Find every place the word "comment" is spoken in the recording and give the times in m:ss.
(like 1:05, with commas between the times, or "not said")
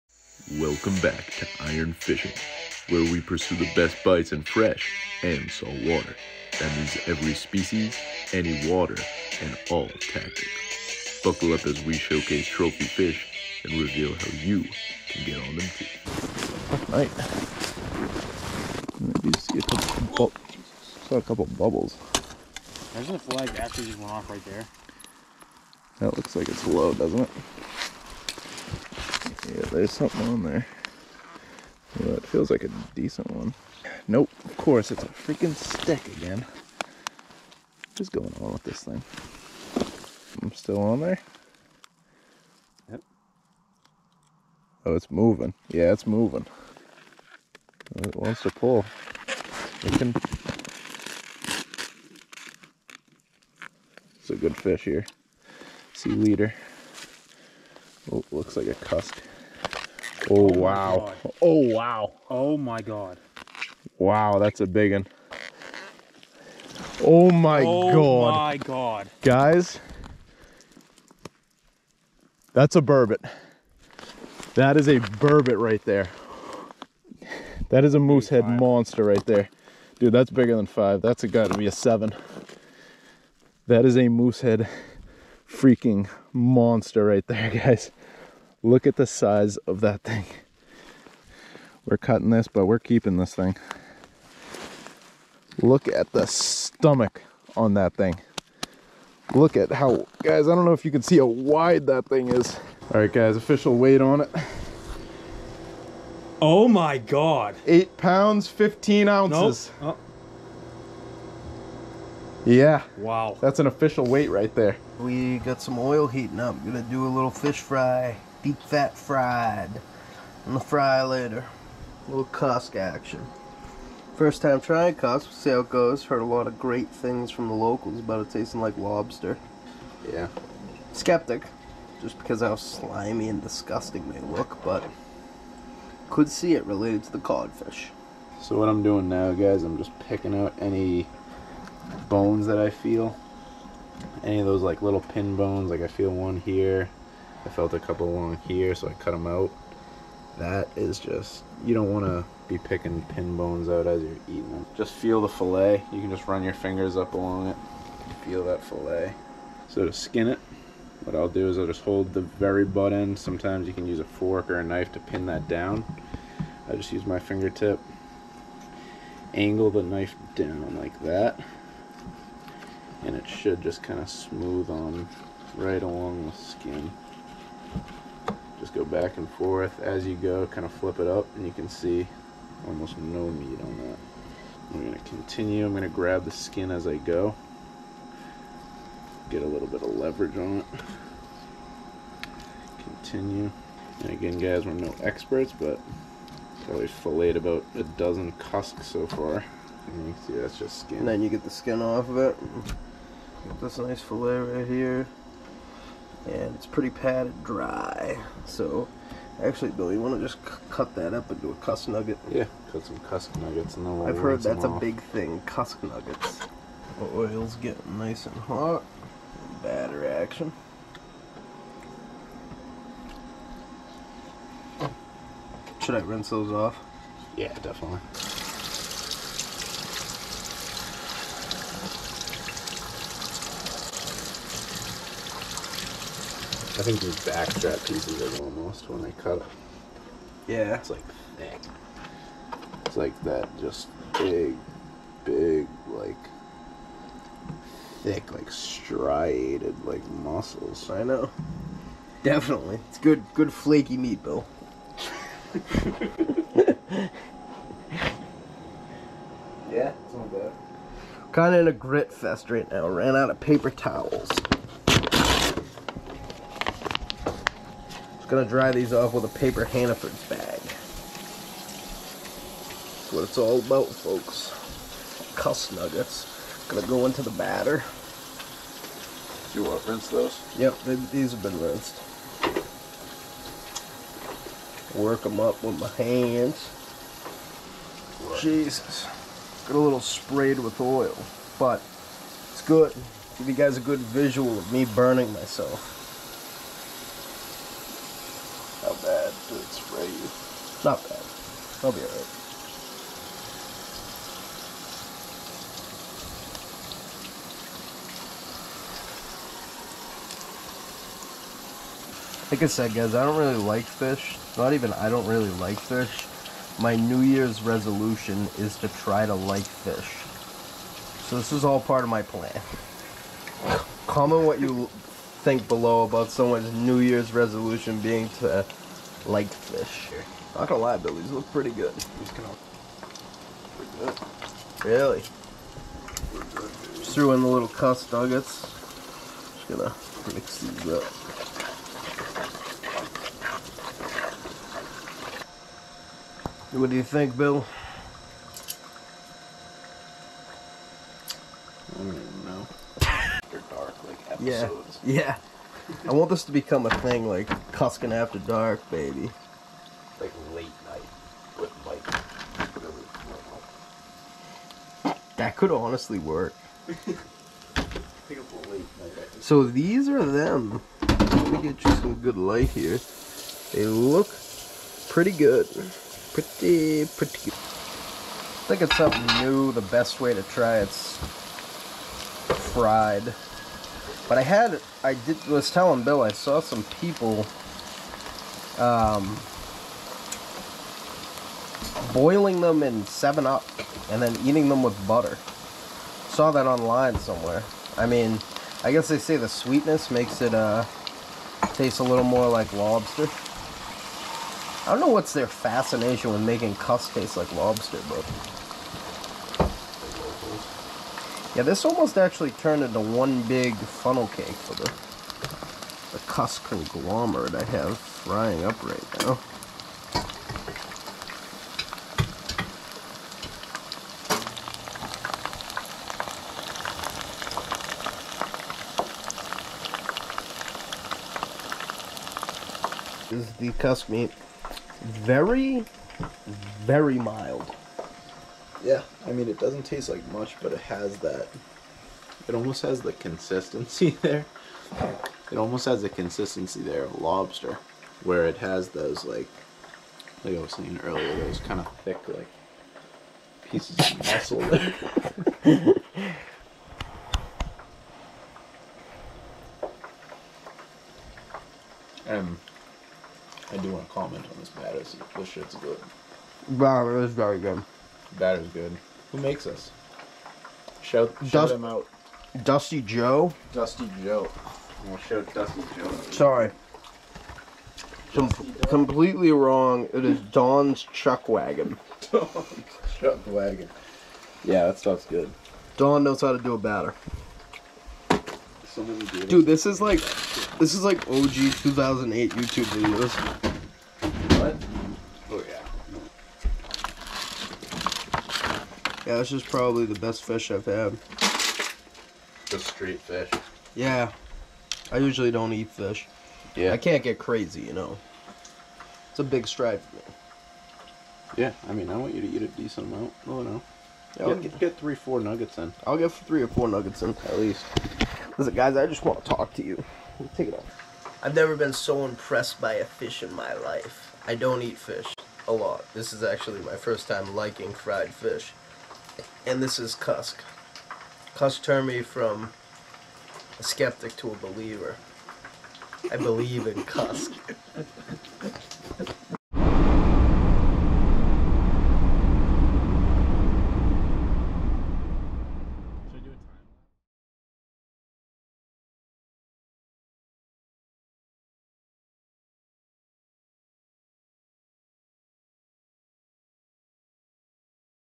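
5:24, 7:44.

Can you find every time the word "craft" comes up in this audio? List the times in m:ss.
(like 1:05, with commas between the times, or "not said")
not said.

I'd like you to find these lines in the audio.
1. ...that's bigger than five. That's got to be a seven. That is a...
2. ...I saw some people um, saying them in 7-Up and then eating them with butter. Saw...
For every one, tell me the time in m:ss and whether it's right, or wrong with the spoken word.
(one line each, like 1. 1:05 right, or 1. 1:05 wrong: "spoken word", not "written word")
1. 1:20 right
2. 6:26 wrong: "boiling", not "saying".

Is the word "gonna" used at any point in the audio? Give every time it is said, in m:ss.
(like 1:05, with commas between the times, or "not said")
1:56, 4:28, 4:36, 5:30, 5:39.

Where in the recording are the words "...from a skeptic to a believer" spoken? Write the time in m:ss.
8:52.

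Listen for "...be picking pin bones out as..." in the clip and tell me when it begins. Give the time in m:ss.
2:32.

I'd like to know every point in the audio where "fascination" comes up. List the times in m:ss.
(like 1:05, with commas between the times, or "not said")
6:45.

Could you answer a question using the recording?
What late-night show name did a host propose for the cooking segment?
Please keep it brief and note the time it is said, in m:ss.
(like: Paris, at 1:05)
Cuskin After Dark, at 5:57.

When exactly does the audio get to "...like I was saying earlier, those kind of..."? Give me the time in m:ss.
7:30.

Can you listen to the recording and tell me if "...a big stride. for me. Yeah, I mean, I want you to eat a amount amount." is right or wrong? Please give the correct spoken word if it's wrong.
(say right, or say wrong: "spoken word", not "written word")
wrong: "decent", not "amount".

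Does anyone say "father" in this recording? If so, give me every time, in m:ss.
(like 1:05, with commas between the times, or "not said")
not said.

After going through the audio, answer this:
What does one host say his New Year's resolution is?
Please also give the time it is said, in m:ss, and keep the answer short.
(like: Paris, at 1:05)
To try to like fish, at 5:18.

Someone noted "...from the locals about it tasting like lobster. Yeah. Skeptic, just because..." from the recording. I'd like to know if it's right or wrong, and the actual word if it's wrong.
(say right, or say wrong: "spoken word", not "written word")
right.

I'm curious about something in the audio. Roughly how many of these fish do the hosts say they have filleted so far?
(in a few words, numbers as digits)
About a dozen.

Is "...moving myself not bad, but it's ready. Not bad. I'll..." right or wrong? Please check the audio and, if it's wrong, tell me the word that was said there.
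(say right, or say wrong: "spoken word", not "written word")
wrong: "burning", not "moving".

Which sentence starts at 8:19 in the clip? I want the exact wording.
Yeah, this is probably the best fish I've had.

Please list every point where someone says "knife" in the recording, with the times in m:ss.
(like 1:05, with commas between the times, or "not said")
2:44, 2:49.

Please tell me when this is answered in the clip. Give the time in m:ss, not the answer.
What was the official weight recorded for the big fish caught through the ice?
1:47.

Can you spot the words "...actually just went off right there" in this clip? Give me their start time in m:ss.
0:23.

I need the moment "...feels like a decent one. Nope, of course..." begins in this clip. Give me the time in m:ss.
0:32.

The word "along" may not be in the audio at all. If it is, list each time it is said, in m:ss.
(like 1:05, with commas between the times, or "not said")
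2:28, 2:37, 2:55.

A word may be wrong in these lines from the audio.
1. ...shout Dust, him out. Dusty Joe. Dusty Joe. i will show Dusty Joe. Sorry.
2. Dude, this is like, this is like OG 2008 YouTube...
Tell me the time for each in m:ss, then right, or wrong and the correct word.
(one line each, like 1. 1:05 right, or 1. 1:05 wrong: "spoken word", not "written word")
1. 7:51 right
2. 8:09 right.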